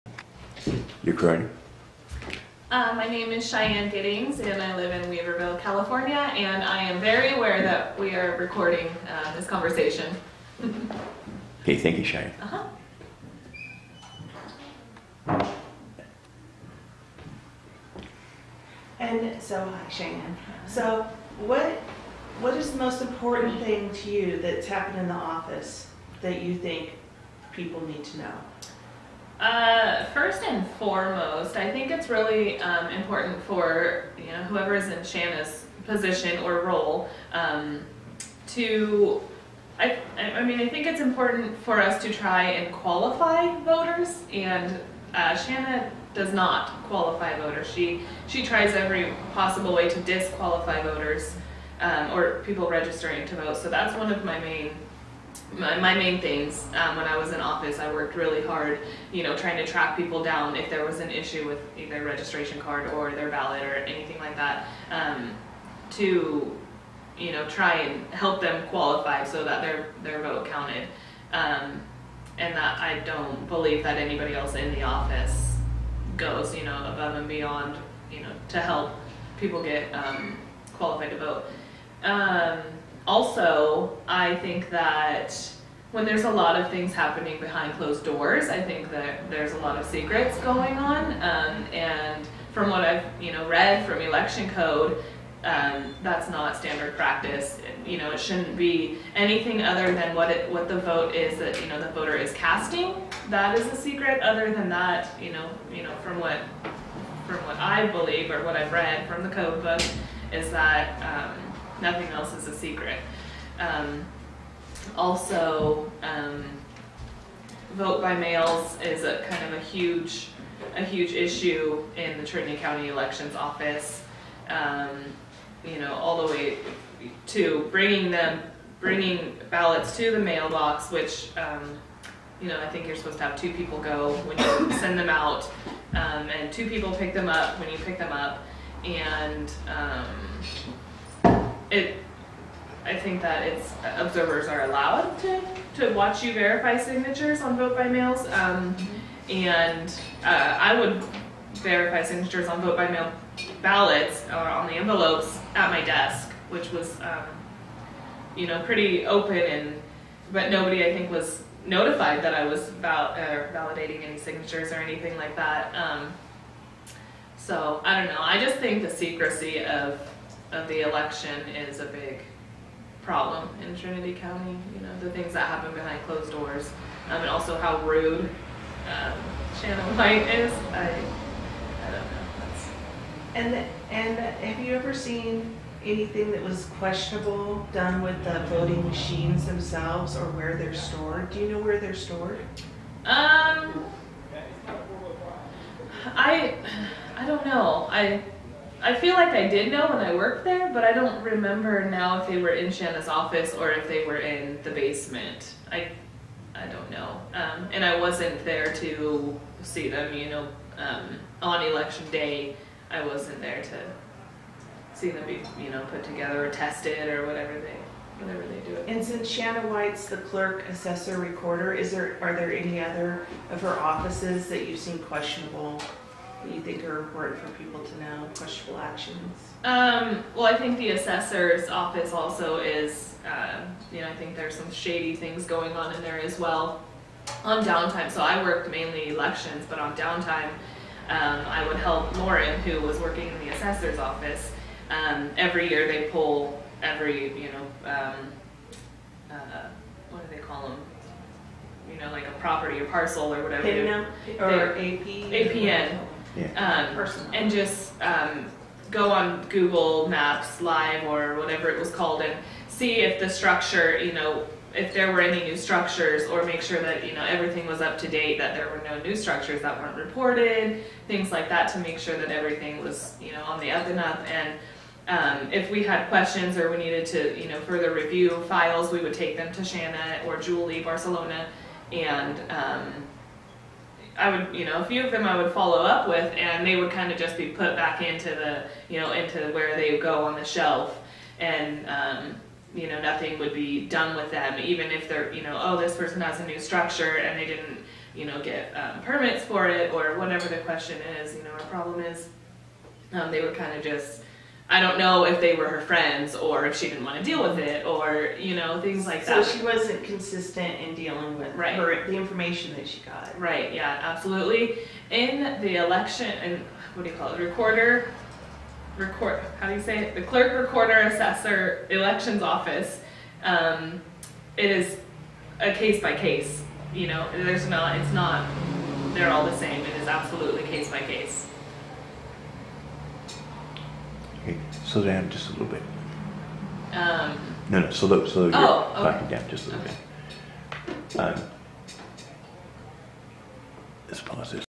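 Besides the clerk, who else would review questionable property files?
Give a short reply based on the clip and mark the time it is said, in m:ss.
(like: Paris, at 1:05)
Julie Barcelona, at 4:40.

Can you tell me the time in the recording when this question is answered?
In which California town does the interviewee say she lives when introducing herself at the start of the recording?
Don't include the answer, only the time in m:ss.
0:05.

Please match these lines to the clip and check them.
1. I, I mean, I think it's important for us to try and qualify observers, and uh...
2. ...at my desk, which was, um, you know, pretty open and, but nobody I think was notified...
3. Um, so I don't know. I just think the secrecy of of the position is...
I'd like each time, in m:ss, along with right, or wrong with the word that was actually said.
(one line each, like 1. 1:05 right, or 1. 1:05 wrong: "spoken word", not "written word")
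1. 0:39 wrong: "voters", not "observers"
2. 2:35 right
3. 2:45 wrong: "election", not "position".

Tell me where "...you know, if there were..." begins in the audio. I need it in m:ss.
4:23.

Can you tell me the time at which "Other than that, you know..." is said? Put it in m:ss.
1:44.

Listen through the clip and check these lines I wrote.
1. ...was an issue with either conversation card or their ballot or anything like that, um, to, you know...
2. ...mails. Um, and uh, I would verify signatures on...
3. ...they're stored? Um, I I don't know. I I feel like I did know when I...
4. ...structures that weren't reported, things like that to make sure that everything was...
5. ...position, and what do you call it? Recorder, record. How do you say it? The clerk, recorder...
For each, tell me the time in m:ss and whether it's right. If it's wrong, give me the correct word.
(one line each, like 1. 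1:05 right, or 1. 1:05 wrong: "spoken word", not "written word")
1. 1:00 wrong: "registration", not "conversation"
2. 2:27 right
3. 3:11 right
4. 4:29 right
5. 5:15 wrong: "election", not "position".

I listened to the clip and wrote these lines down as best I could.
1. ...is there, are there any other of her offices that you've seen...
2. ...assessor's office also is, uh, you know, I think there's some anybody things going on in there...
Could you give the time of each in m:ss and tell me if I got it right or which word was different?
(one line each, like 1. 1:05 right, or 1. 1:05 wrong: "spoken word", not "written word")
1. 3:41 right
2. 3:50 wrong: "shady", not "anybody".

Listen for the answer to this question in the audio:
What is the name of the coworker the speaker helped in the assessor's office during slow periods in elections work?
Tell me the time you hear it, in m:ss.
4:02.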